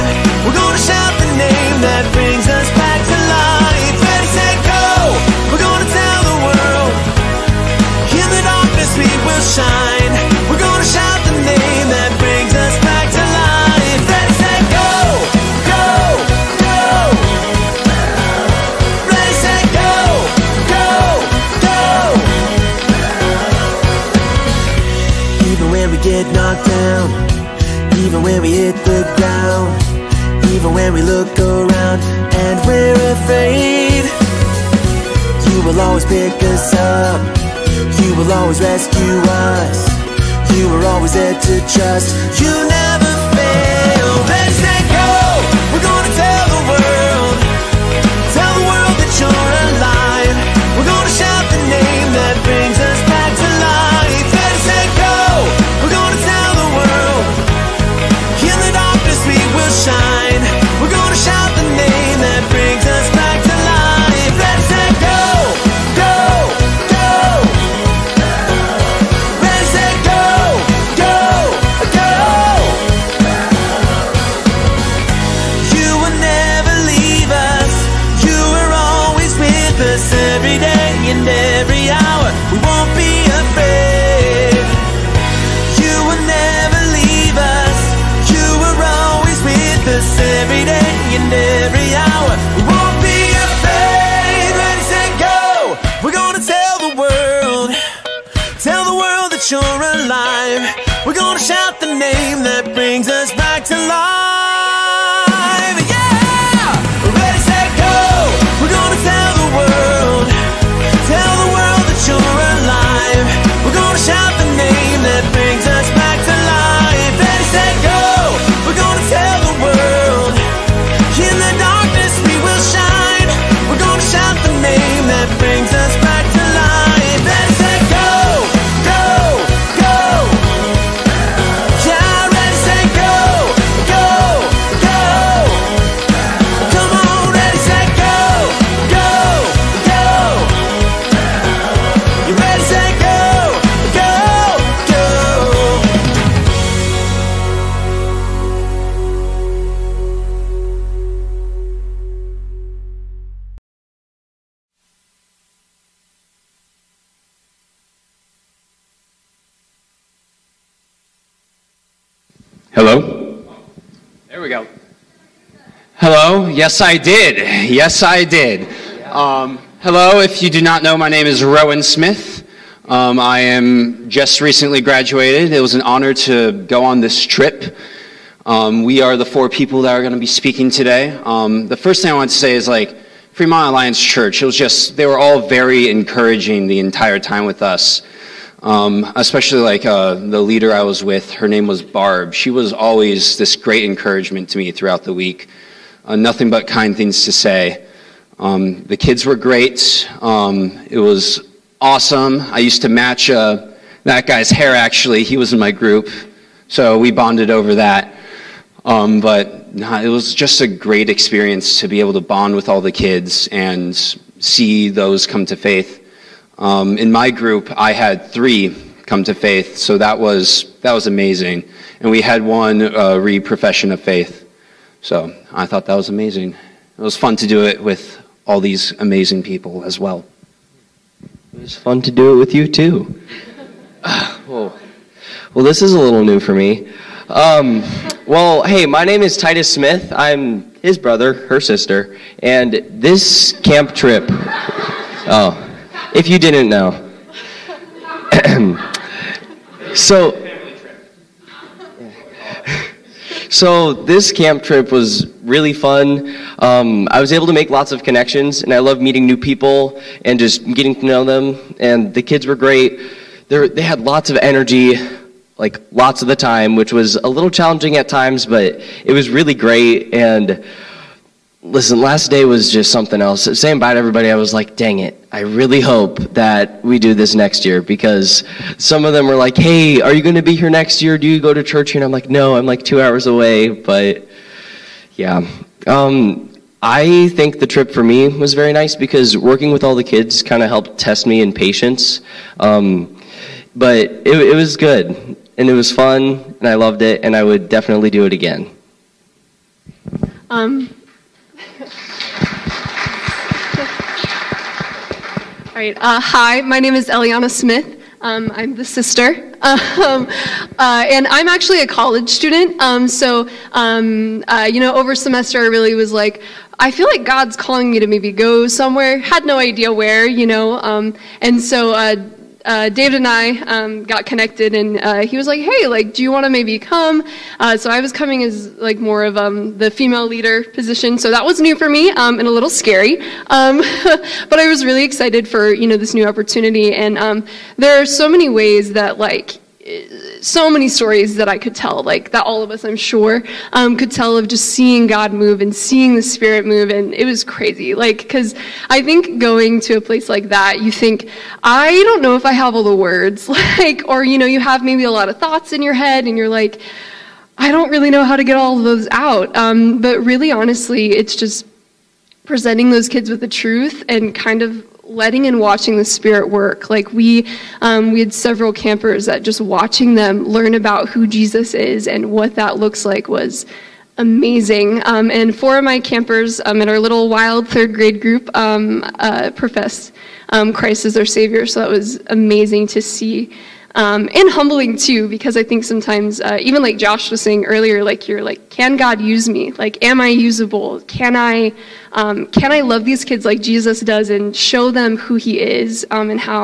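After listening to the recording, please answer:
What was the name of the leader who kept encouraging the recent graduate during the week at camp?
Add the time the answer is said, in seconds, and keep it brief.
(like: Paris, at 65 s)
Barb, at 191 s.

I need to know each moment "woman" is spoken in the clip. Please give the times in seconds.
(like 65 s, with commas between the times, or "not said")
not said.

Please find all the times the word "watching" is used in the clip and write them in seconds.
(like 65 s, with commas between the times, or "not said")
365 s, 369 s.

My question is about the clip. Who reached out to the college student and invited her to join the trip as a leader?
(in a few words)
David.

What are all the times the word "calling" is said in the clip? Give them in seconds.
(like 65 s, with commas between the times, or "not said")
317 s.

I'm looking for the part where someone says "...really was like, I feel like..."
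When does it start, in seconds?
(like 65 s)
315 s.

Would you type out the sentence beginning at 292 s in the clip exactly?
Um, but it, it was good and it was fun and I loved it and I would definitely do it again.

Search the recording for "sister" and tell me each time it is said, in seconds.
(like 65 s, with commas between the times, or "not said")
241 s, 308 s.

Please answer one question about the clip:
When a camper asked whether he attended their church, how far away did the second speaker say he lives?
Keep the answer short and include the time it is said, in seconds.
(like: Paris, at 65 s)
2 hours, at 282 s.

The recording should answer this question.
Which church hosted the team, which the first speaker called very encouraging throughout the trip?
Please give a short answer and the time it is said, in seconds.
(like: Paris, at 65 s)
Fremont Alliance Church, at 183 s.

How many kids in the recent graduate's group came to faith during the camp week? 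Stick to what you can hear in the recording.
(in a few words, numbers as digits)
3.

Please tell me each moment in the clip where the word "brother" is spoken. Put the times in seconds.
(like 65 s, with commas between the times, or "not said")
240 s.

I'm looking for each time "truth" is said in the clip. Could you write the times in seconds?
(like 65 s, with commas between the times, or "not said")
363 s.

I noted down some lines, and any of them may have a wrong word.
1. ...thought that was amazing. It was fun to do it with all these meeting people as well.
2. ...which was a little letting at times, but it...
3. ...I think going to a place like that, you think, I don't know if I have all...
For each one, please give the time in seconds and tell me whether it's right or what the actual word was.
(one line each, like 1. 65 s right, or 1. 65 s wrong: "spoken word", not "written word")
1. 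225 s wrong: "amazing", not "meeting"
2. 266 s wrong: "challenging", not "letting"
3. 348 s right.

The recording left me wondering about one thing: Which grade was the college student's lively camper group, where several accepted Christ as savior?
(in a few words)
Third grade.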